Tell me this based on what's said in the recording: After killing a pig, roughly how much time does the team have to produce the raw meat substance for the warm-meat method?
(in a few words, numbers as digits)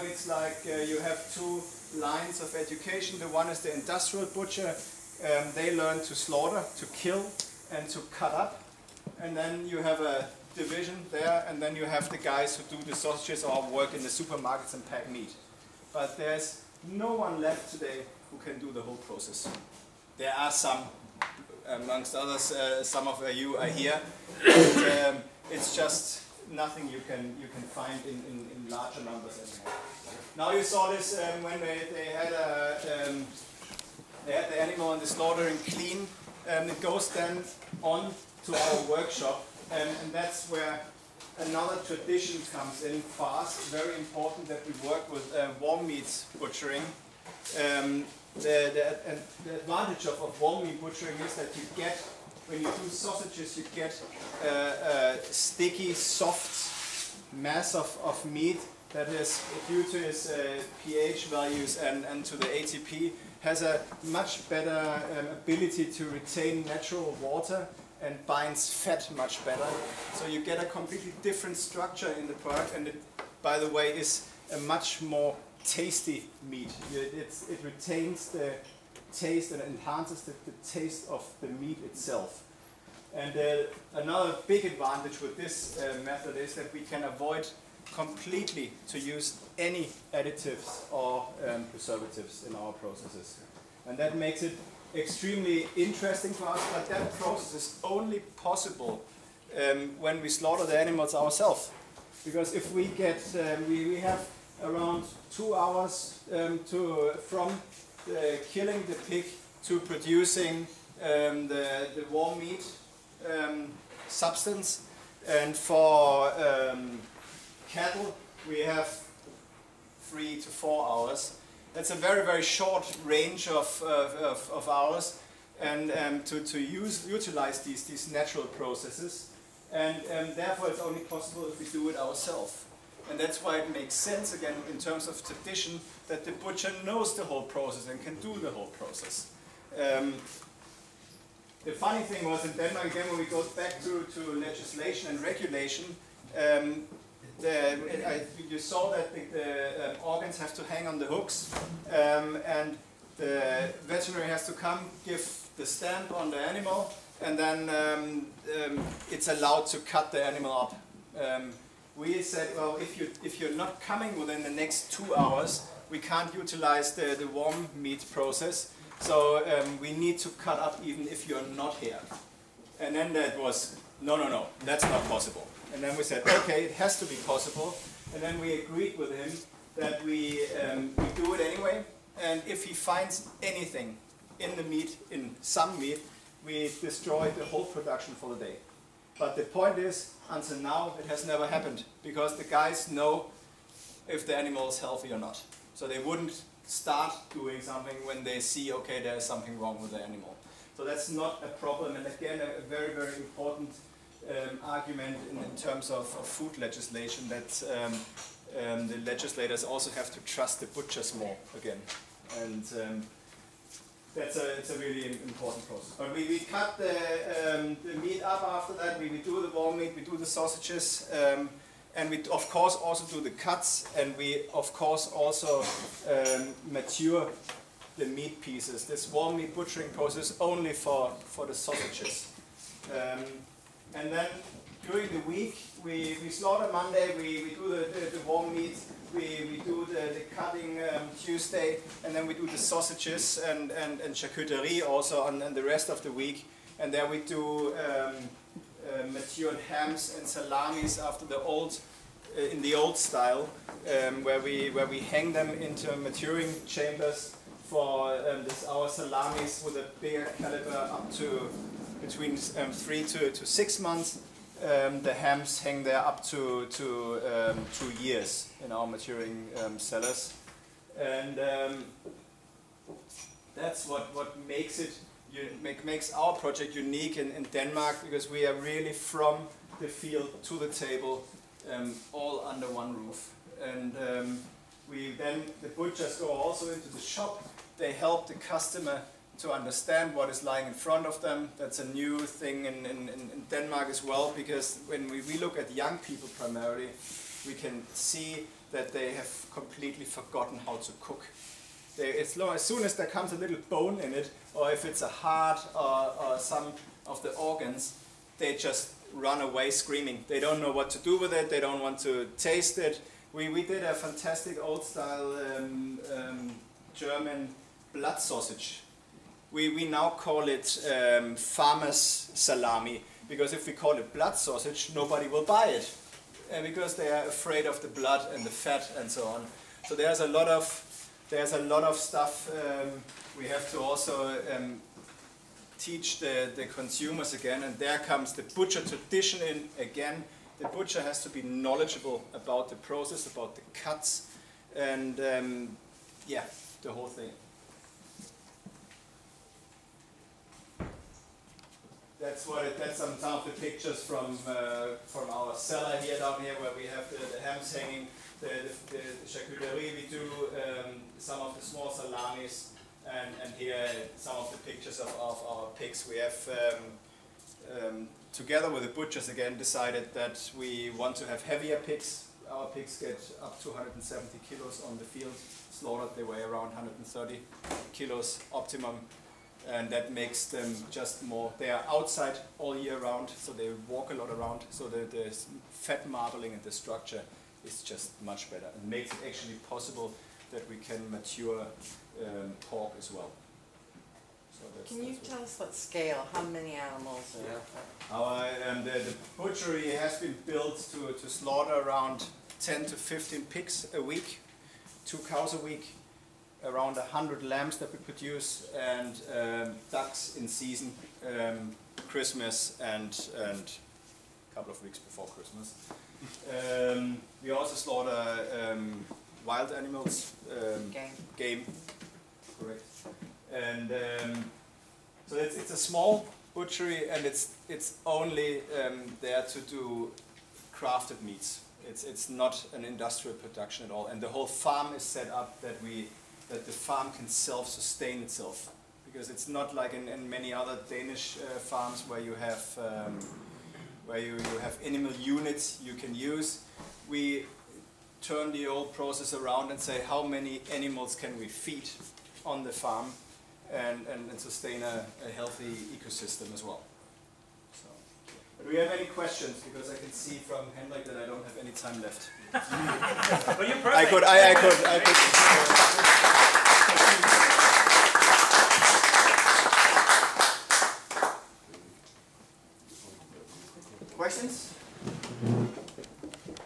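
2 hours.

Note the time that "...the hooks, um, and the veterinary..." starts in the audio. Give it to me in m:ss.
2:30.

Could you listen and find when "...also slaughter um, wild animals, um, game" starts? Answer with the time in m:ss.
6:57.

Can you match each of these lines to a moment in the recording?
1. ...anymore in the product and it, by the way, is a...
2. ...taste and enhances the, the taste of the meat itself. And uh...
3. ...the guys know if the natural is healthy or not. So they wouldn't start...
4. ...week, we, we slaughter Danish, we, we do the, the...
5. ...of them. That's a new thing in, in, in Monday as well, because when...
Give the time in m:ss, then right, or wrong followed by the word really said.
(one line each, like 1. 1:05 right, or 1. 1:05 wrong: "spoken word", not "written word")
1. 1:11 wrong: "structure", not "anymore"
2. 1:19 right
3. 3:12 wrong: "animal", not "natural"
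4. 3:55 wrong: "Monday", not "Danish"
5. 4:51 wrong: "Denmark", not "Monday".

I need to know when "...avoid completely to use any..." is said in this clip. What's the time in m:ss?
1:27.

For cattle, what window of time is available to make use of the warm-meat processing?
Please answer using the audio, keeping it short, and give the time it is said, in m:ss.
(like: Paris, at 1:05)
3 to 4 hours, at 2:00.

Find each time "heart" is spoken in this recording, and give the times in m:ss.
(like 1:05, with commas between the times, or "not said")
5:05.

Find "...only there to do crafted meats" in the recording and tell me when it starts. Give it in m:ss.
7:08.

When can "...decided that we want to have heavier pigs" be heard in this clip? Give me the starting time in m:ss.
6:09.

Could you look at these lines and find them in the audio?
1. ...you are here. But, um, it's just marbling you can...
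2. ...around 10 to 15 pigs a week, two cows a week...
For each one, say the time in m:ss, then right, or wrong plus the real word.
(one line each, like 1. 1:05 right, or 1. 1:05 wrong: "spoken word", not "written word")
1. 0:23 wrong: "nothing", not "marbling"
2. 6:41 right.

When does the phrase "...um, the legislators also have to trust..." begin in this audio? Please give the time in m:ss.
3:28.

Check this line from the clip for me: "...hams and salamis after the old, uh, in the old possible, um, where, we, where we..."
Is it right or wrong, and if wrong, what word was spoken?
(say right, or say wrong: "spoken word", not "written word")
wrong: "style", not "possible".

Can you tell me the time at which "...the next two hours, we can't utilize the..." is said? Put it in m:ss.
2:44.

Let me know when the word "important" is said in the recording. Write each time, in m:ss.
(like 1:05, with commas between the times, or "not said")
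0:43, 3:23, 3:35.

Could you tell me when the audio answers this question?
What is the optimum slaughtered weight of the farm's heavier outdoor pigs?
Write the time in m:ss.
6:16.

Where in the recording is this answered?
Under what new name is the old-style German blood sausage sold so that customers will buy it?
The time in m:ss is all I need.
5:21.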